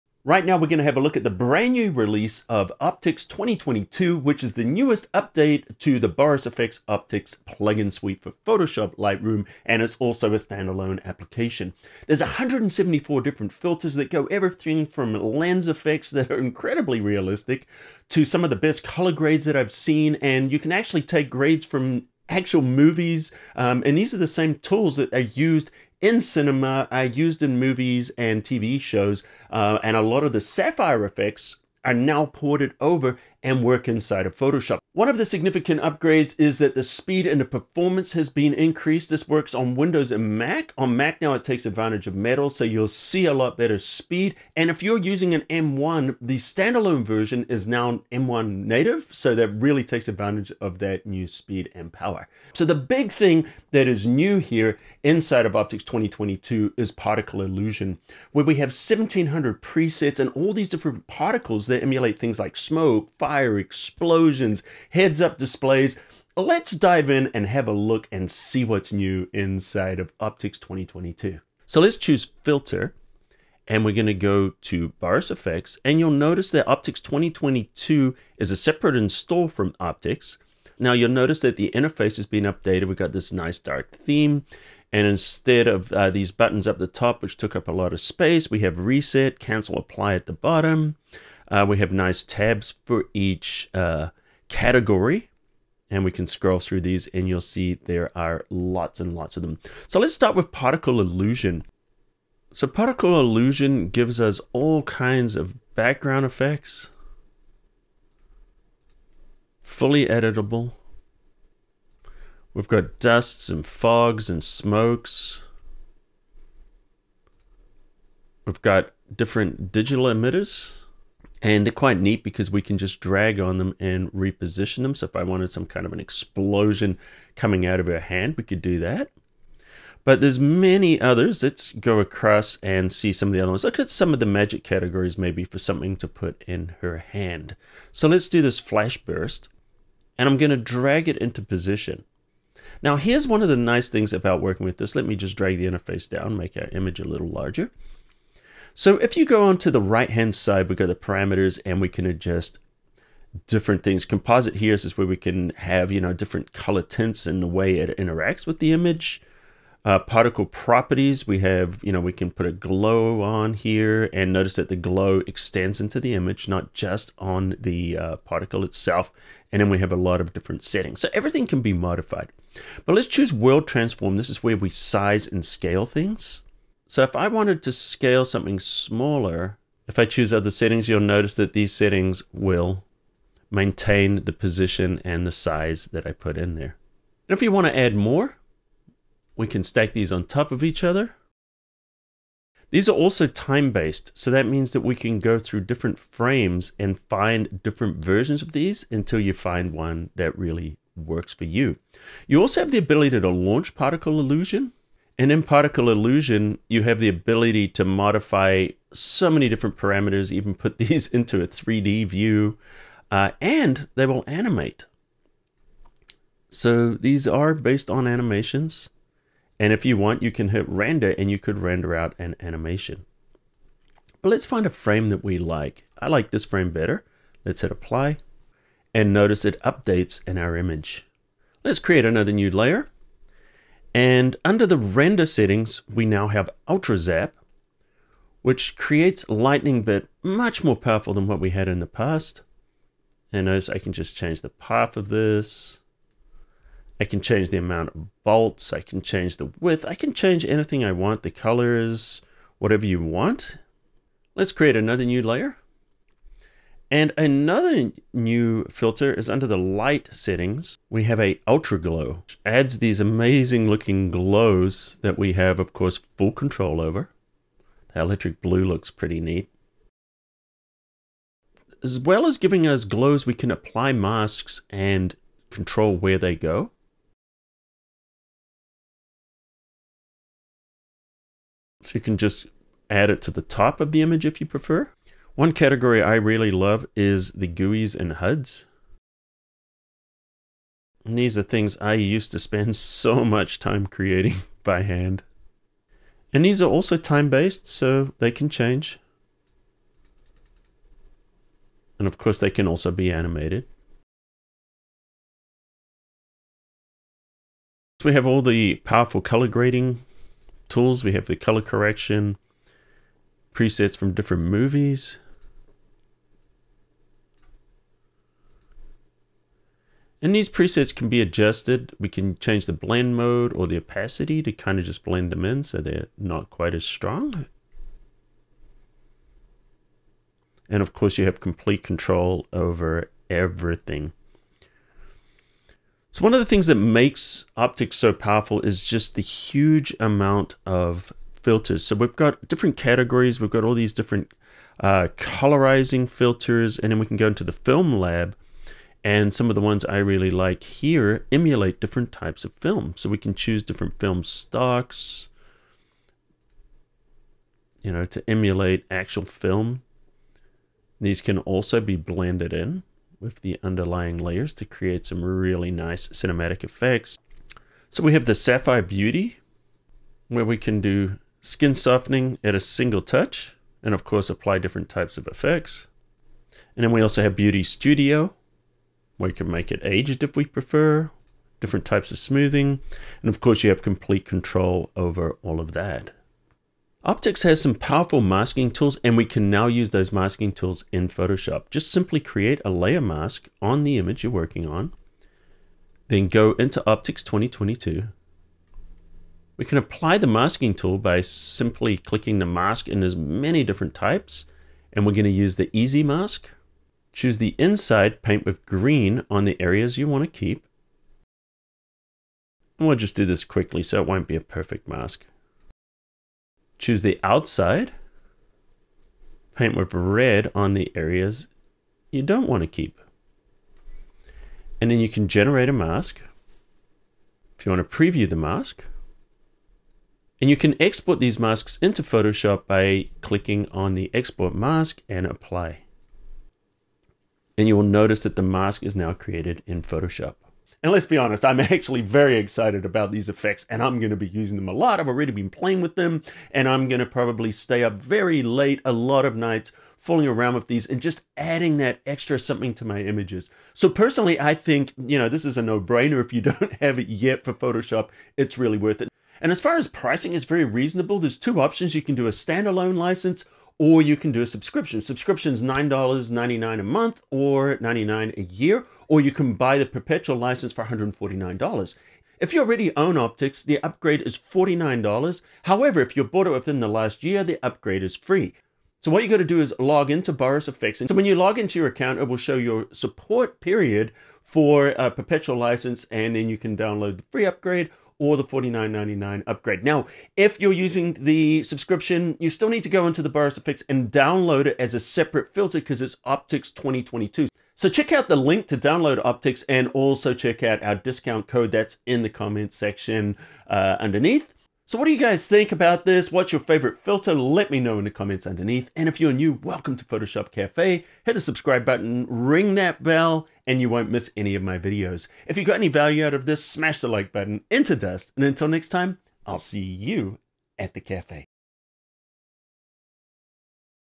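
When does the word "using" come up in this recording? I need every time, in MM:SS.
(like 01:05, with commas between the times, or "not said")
00:44, 07:24, 08:10.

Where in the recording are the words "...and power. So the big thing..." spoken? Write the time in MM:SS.
00:51.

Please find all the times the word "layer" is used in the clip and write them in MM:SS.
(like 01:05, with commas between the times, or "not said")
03:52, 04:15, 06:04, 06:32.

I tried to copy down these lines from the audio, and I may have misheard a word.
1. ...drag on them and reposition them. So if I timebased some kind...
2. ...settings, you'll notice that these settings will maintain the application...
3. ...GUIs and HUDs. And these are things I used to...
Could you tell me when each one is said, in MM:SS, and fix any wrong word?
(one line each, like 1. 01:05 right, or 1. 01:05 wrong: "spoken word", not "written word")
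1. 02:02 wrong: "wanted", not "timebased"
2. 03:00 wrong: "position", not "application"
3. 04:47 right.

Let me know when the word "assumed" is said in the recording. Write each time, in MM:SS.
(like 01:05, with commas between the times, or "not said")
not said.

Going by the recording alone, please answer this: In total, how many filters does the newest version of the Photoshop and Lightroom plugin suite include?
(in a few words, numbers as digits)
174.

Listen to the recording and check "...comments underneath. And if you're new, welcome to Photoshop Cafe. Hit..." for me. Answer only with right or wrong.
right.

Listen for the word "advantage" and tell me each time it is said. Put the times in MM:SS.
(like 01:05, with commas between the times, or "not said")
00:41, 00:50.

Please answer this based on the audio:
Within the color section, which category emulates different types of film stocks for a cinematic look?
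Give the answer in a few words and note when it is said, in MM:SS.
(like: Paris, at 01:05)
Film Lab, at 05:47.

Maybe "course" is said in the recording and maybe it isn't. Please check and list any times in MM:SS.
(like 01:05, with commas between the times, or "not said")
04:25, 05:02, 05:30, 06:14, 06:23.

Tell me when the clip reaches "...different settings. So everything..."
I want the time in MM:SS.
02:50.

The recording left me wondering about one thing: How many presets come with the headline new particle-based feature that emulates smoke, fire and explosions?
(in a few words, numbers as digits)
1700.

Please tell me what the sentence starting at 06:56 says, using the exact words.
Choose the outside, paint with red on the areas you don't want to keep.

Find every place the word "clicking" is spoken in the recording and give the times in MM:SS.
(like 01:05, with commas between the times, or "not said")
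06:41, 07:13.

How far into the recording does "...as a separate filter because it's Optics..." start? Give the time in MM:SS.
08:14.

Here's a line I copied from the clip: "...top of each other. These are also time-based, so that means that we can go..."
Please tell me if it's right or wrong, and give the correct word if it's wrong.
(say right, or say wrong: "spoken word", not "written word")
right.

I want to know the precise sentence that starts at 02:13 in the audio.
Look at some of the magic categories maybe for something to put in her hand.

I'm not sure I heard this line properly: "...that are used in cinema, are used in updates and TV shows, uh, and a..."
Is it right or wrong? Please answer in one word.
wrong.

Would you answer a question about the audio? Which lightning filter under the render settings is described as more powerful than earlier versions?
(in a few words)
Ultra Zap.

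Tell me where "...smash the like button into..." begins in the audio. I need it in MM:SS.
08:36.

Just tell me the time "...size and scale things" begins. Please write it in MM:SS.
02:54.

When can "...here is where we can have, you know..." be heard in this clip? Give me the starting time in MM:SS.
02:34.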